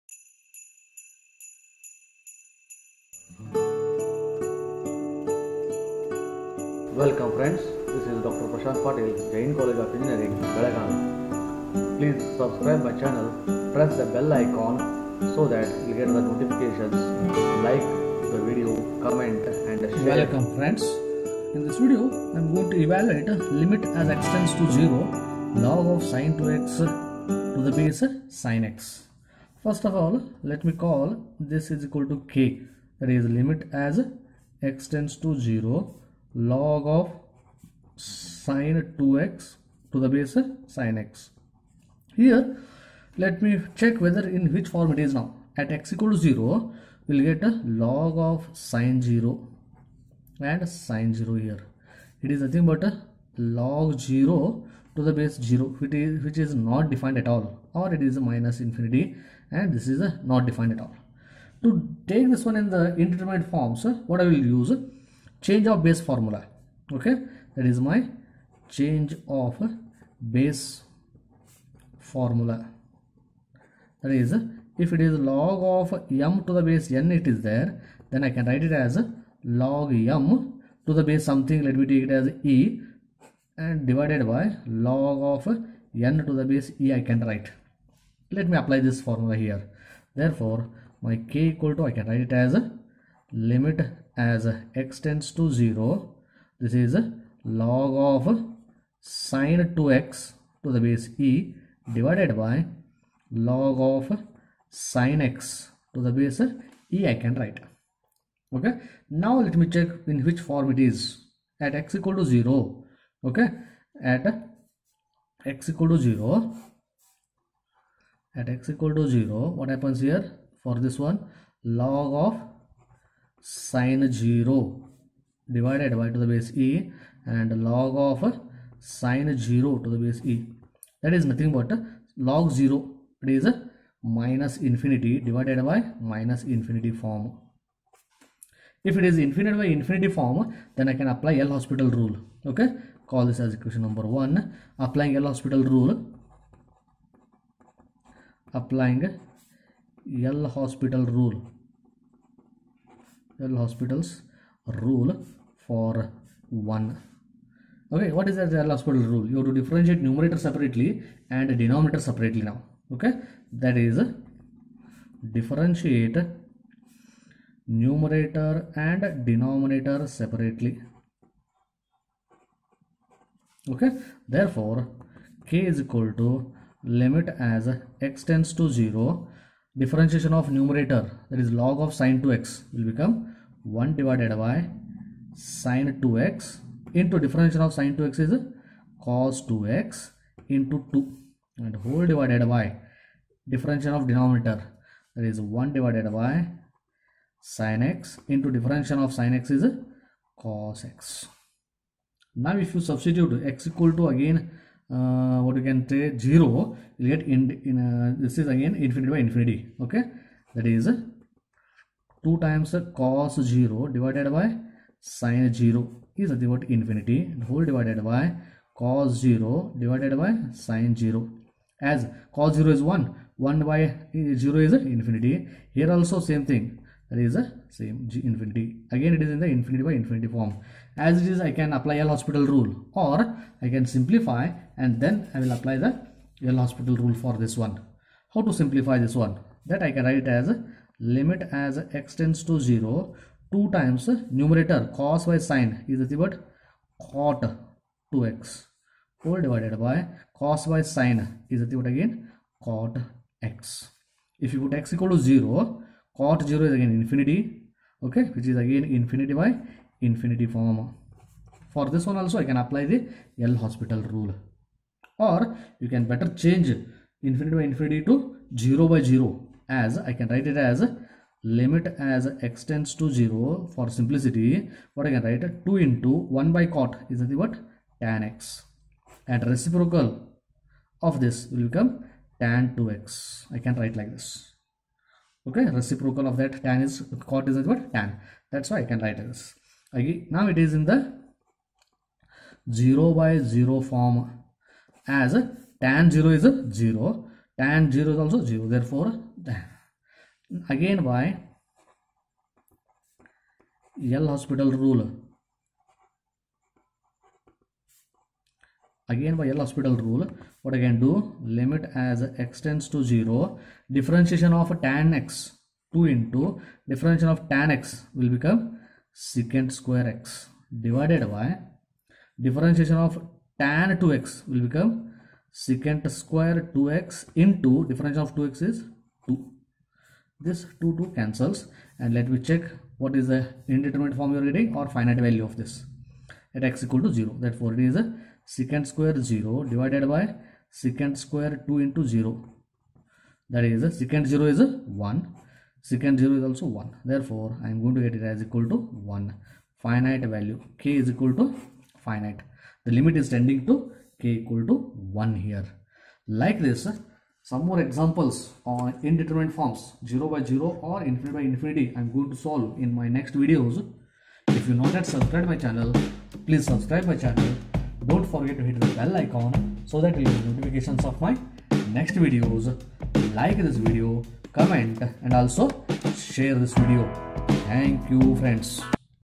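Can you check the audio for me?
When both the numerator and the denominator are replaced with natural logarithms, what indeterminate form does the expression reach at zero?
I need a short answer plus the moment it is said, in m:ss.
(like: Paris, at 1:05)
minus infinity divided by minus infinity, at 2:14.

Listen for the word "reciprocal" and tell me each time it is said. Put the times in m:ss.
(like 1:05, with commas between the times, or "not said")
4:39, 4:45.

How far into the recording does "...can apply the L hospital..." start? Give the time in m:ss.
4:22.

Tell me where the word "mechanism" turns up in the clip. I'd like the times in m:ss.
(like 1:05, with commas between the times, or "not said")
not said.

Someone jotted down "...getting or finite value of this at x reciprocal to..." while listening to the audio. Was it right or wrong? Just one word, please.
wrong.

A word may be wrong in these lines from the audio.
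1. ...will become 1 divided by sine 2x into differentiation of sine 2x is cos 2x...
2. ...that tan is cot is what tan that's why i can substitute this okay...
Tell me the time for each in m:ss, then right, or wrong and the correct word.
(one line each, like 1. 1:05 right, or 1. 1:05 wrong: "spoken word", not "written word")
1. 3:02 right
2. 4:46 wrong: "write", not "substitute".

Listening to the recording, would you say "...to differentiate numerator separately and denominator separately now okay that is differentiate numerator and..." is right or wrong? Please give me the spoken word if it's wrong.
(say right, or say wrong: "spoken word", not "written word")
right.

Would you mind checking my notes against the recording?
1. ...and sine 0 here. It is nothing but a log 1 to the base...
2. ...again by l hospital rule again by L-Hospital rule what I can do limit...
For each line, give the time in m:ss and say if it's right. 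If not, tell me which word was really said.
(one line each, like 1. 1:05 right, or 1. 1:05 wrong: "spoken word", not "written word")
1. 0:50 wrong: "0", not "1"
2. 5:00 right.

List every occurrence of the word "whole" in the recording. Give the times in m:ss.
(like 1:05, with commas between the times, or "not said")
3:11, 3:37, 4:09.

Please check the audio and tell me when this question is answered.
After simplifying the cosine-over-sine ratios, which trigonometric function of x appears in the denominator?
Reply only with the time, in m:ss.
4:12.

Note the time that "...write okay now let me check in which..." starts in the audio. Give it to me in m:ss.
1:47.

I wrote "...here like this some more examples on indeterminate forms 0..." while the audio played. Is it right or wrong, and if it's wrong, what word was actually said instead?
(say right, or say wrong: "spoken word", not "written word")
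right.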